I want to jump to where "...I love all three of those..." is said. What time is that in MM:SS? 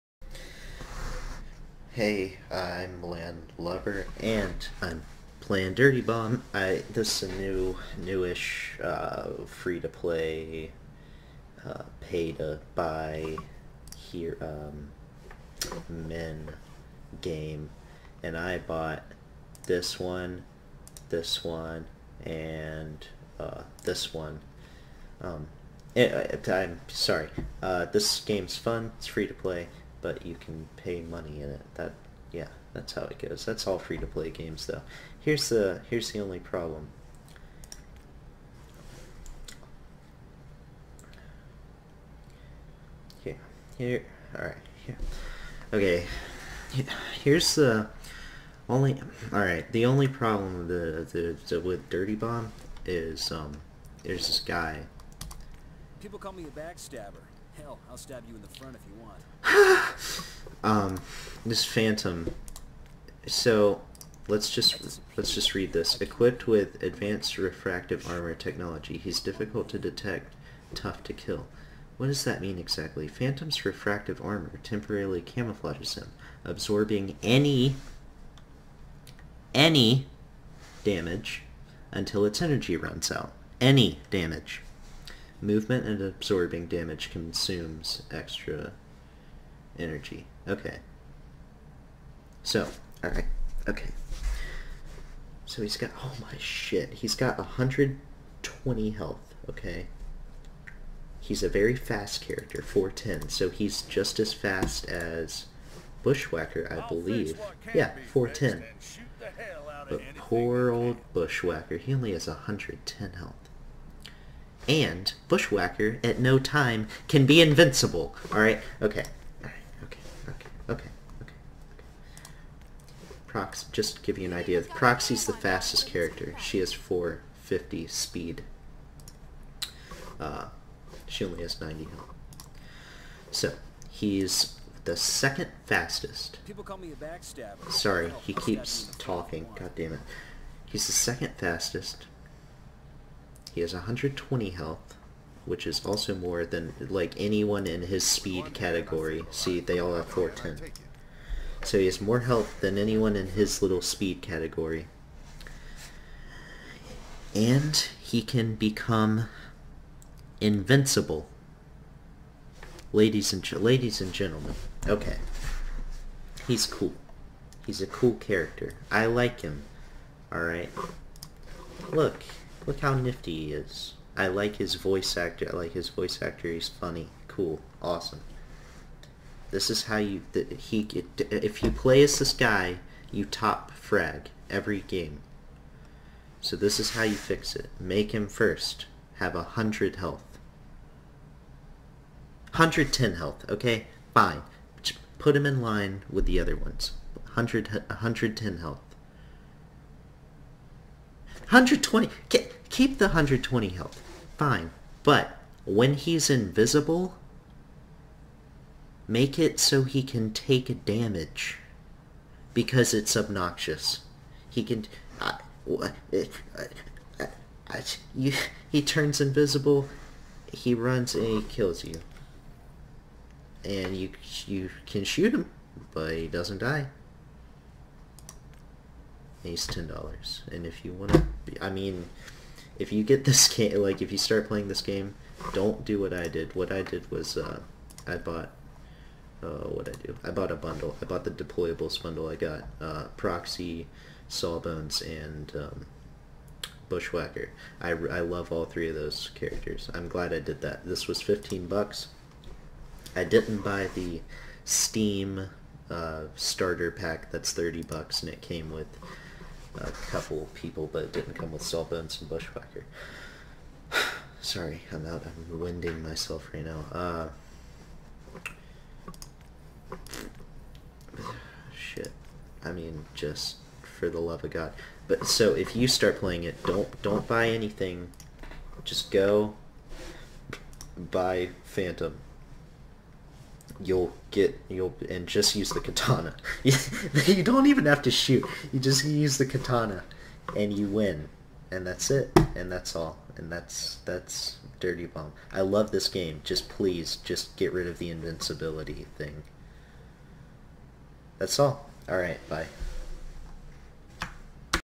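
04:07.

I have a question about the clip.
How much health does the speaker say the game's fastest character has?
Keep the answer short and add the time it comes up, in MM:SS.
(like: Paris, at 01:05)
90, at 02:11.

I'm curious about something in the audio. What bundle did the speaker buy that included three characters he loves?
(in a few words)
Deployables bundle.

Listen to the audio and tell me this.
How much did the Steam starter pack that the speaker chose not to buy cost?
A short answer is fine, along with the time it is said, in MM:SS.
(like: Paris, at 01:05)
$30, at 04:17.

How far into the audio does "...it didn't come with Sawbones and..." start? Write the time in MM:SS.
04:21.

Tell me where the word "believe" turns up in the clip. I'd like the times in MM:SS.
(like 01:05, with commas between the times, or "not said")
01:46.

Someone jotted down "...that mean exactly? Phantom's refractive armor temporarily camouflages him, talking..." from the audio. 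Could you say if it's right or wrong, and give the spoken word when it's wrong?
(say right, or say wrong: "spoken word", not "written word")
wrong: "absorbing", not "talking".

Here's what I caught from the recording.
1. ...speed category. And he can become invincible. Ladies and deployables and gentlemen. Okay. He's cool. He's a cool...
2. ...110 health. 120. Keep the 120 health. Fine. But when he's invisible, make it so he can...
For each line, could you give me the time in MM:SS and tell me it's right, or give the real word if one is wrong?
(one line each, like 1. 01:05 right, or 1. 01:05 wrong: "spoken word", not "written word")
1. 02:33 wrong: "ladies", not "deployables"
2. 03:17 right.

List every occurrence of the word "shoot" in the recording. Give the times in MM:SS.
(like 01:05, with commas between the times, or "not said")
03:45, 04:48.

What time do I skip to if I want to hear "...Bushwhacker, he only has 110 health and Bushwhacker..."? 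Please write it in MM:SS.
01:51.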